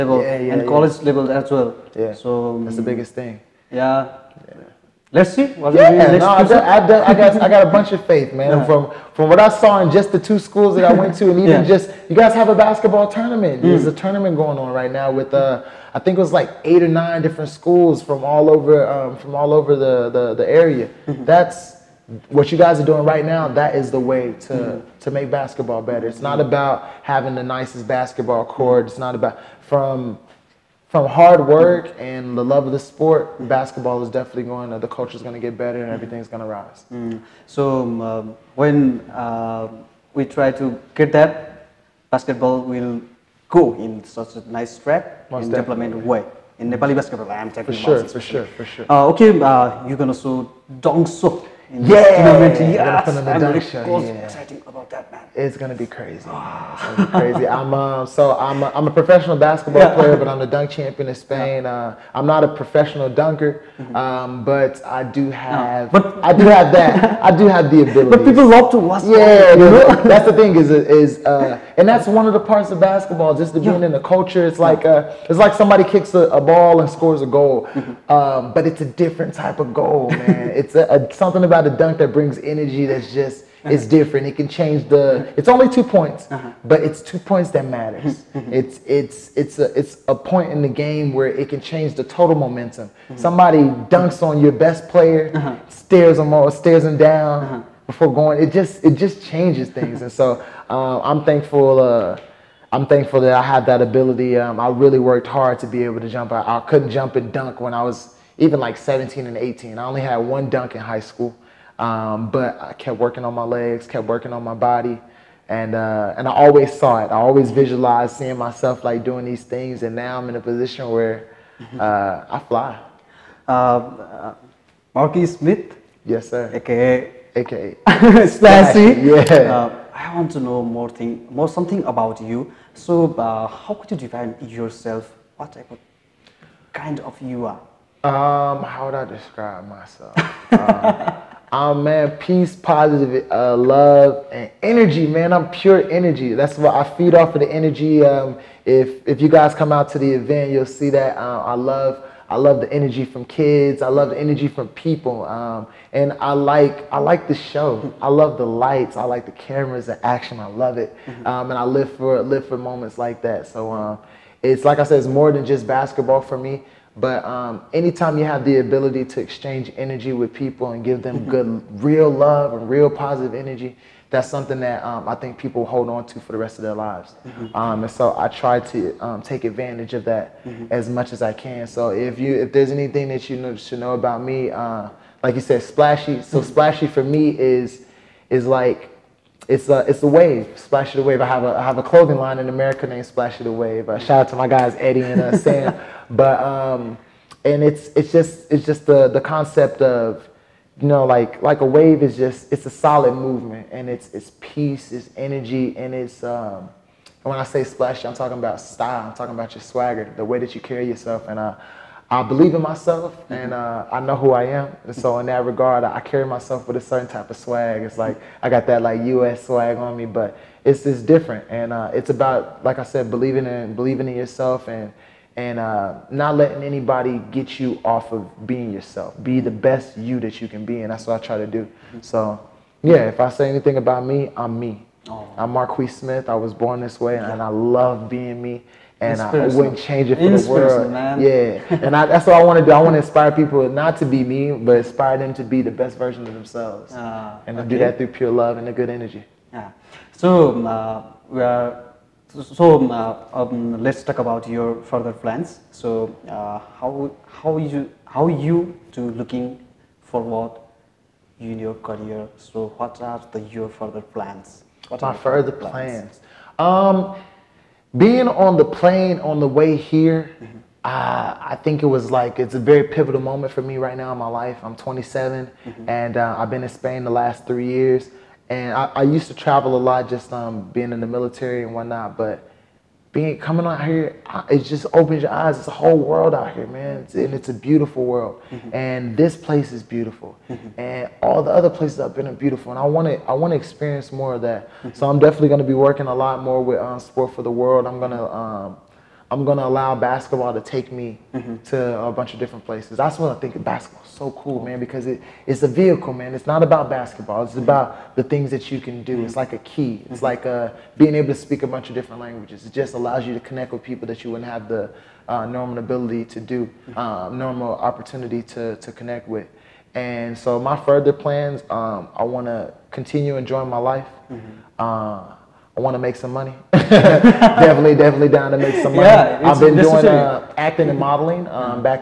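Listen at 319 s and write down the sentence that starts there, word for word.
And so my further plans, um, I want to continue enjoying my life.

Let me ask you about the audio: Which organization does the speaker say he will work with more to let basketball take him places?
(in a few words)
Sport for the World.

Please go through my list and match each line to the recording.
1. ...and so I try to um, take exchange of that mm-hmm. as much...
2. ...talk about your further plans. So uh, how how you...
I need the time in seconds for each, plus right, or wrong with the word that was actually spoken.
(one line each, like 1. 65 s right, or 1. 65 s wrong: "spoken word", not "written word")
1. 177 s wrong: "advantage", not "exchange"
2. 254 s right.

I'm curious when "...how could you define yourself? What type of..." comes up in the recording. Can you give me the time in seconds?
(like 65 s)
133 s.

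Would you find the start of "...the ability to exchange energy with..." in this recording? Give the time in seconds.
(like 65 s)
168 s.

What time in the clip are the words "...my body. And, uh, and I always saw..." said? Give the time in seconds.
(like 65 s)
114 s.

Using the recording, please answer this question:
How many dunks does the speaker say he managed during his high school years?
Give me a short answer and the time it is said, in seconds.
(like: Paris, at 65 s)
1, at 110 s.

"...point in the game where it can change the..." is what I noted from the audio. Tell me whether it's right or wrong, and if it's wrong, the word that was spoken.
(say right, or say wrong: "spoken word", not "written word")
right.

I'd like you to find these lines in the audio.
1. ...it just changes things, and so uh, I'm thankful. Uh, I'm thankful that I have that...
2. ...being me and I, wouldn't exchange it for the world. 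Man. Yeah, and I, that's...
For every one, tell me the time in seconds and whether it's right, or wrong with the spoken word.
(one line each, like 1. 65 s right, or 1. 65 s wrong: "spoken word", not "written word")
1. 98 s right
2. 238 s wrong: "change", not "exchange".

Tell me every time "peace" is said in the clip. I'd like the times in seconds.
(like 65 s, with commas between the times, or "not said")
142 s, 204 s.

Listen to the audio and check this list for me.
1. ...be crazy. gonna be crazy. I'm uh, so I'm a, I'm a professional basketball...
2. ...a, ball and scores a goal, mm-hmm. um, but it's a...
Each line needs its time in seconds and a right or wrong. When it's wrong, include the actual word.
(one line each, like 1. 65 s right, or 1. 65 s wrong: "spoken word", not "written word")
1. 55 s right
2. 76 s right.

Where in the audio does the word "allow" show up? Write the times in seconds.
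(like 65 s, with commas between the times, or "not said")
299 s, 312 s.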